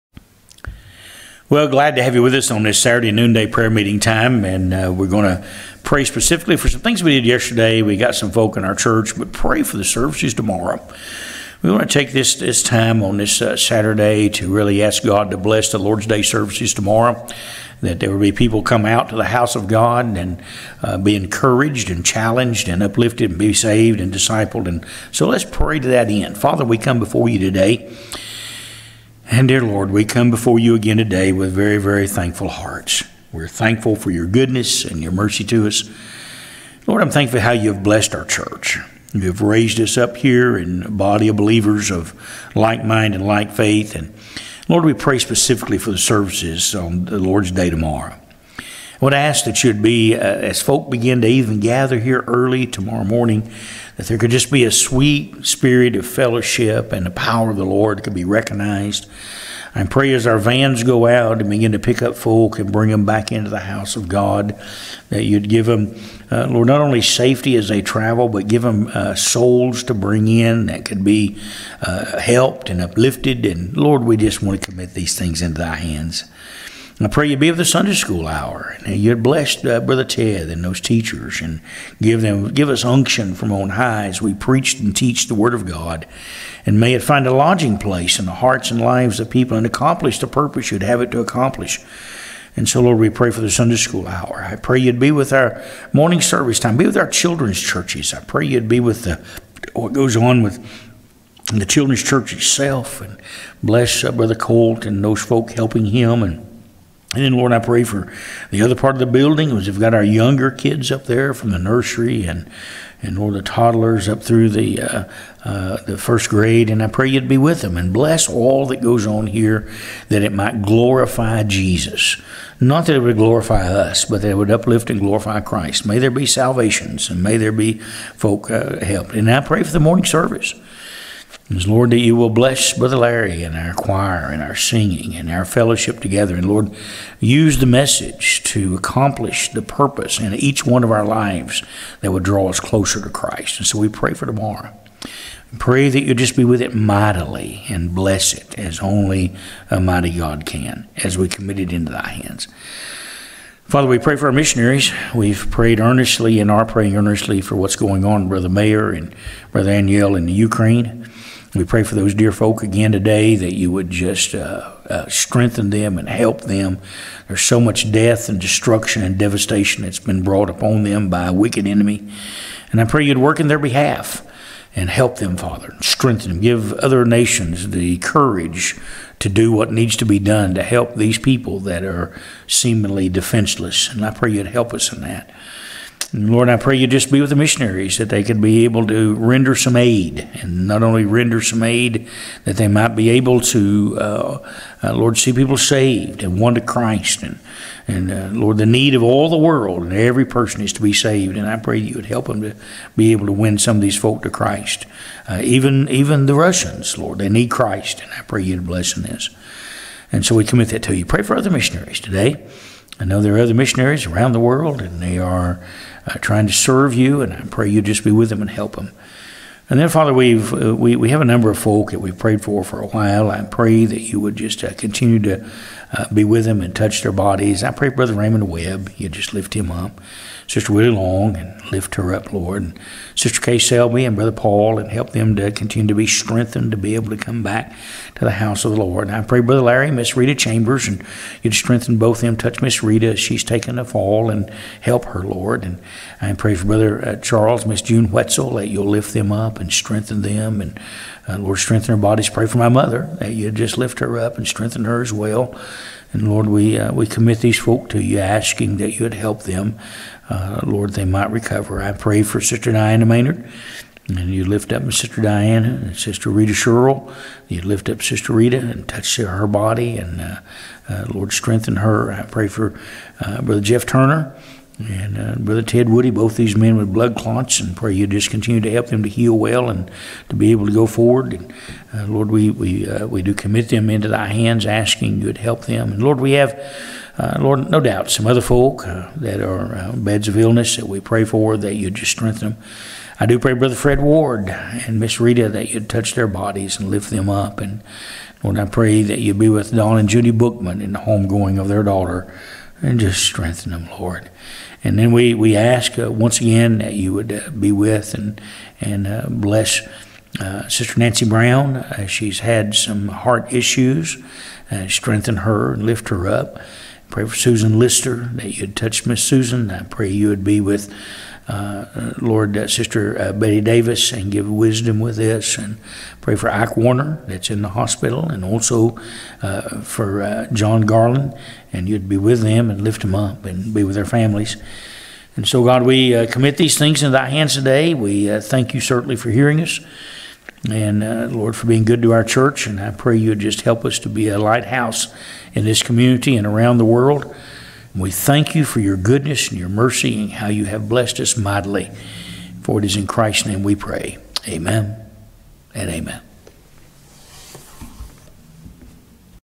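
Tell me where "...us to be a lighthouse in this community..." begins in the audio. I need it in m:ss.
5:43.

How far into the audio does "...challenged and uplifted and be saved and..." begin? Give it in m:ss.
0:22.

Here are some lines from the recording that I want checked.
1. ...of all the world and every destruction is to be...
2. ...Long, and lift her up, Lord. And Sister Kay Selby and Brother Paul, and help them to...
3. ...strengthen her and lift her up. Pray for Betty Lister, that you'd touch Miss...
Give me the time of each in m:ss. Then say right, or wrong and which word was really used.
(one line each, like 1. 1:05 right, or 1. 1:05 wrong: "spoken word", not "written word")
1. 3:18 wrong: "person", not "destruction"
2. 3:50 right
3. 5:14 wrong: "Susan", not "Betty".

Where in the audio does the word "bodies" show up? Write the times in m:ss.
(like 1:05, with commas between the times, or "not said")
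3:47, 4:12, 4:56.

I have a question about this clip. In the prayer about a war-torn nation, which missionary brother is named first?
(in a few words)
Brother Mayer.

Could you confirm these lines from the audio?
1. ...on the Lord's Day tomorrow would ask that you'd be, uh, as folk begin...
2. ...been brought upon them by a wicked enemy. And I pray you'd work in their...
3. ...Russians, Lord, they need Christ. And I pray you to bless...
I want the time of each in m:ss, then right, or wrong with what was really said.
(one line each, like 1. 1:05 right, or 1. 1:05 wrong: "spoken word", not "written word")
1. 0:46 right
2. 2:49 right
3. 3:26 right.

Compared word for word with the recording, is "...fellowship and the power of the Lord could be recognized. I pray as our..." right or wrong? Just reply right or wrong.
right.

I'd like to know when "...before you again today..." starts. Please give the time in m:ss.
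0:30.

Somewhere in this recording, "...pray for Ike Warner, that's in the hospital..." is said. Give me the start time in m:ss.
5:26.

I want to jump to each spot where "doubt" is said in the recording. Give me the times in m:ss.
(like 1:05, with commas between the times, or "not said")
4:47.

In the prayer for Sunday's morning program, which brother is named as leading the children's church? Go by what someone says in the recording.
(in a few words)
Brother Colt.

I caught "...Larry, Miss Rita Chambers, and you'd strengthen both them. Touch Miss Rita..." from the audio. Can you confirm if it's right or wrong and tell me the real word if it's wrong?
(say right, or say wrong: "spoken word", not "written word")
right.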